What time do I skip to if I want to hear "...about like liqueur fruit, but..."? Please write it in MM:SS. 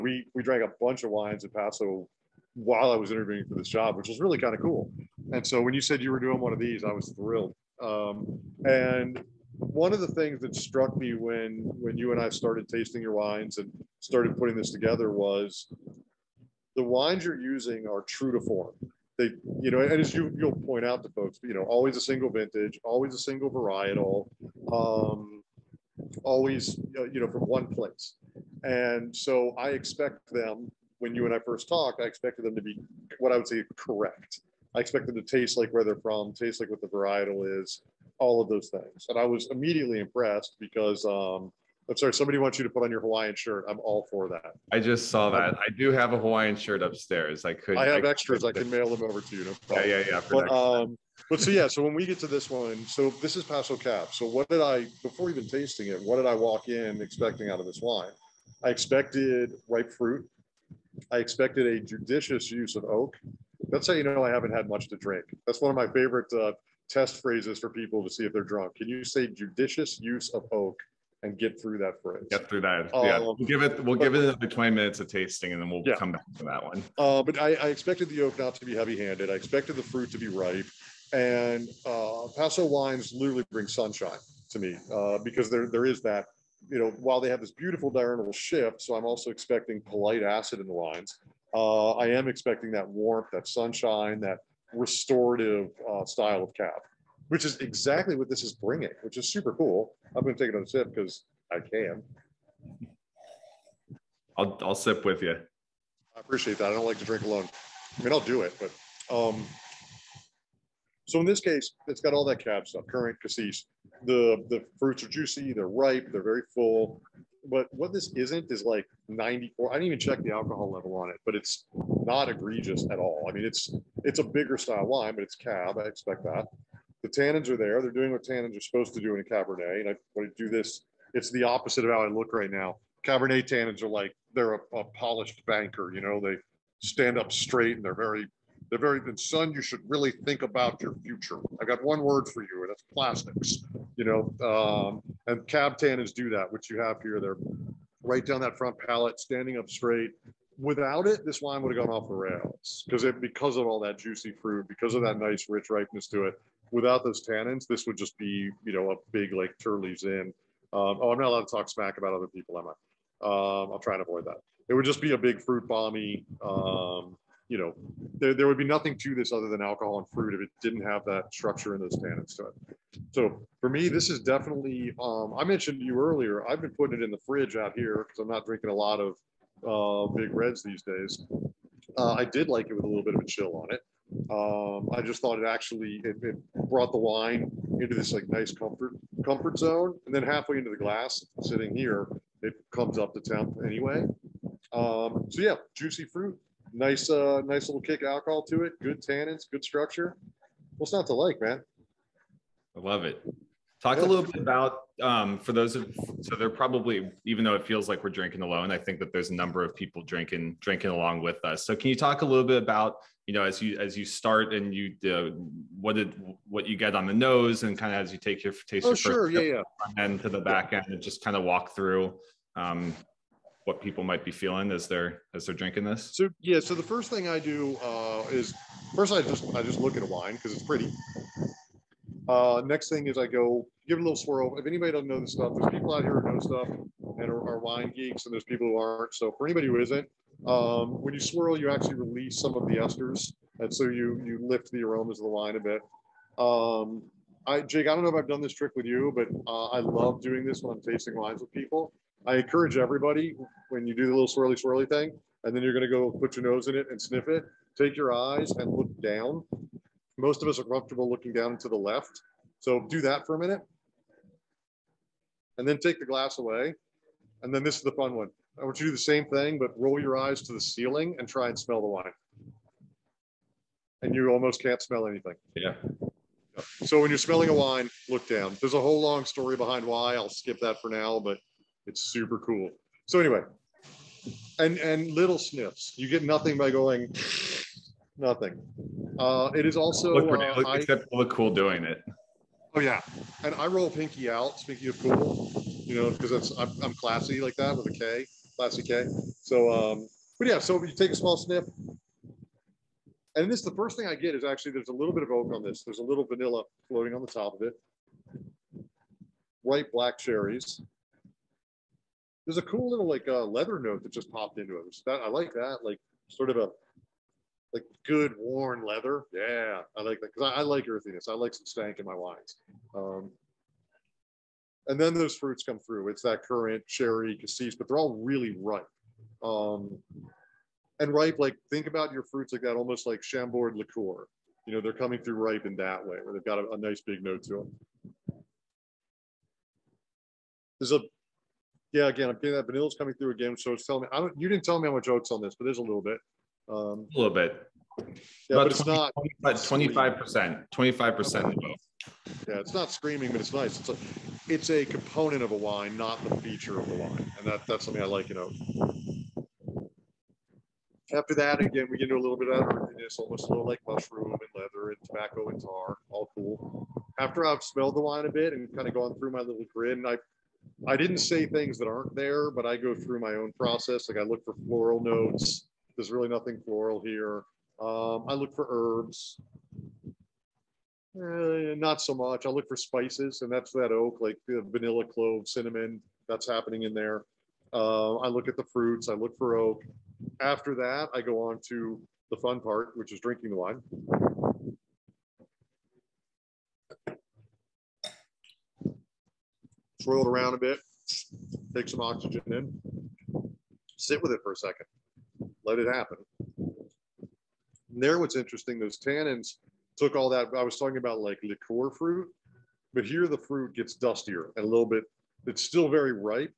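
06:50.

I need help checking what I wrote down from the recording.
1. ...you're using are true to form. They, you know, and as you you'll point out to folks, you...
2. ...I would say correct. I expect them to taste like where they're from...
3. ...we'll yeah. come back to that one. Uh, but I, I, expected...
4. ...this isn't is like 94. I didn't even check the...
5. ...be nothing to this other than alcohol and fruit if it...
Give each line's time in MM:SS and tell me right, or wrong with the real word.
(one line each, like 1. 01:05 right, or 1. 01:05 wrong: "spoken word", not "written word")
1. 00:17 right
2. 00:33 right
3. 01:15 right
4. 01:57 right
5. 02:48 right.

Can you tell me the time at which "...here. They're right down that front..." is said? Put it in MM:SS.
02:27.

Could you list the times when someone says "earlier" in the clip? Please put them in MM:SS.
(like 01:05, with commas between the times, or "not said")
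02:56.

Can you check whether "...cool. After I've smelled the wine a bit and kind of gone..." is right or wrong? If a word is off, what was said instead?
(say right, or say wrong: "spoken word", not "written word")
right.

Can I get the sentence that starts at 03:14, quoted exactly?
Um, so yeah, juicy fruit, nice, uh, nice little kick alcohol to it.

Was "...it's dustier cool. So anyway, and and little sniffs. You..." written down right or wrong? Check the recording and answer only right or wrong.
wrong.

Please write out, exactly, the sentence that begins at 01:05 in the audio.
That's one of my favorite uh, test phrases for people to see if they're drunk.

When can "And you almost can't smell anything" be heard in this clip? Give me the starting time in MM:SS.
04:34.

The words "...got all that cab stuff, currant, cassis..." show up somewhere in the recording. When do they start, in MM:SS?
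01:52.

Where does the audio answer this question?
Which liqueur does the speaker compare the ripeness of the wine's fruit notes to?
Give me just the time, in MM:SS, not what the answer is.
05:33.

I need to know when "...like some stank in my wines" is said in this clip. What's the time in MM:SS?
05:21.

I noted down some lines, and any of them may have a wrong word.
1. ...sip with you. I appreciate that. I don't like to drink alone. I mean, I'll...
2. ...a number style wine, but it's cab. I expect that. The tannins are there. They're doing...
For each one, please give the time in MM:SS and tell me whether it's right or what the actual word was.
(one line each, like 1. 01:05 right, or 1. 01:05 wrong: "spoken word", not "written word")
1. 01:44 right
2. 02:04 wrong: "bigger", not "number".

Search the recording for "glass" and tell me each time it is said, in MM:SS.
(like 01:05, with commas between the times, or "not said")
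03:10, 04:26.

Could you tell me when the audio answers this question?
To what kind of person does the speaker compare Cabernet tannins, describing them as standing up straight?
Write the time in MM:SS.
02:14.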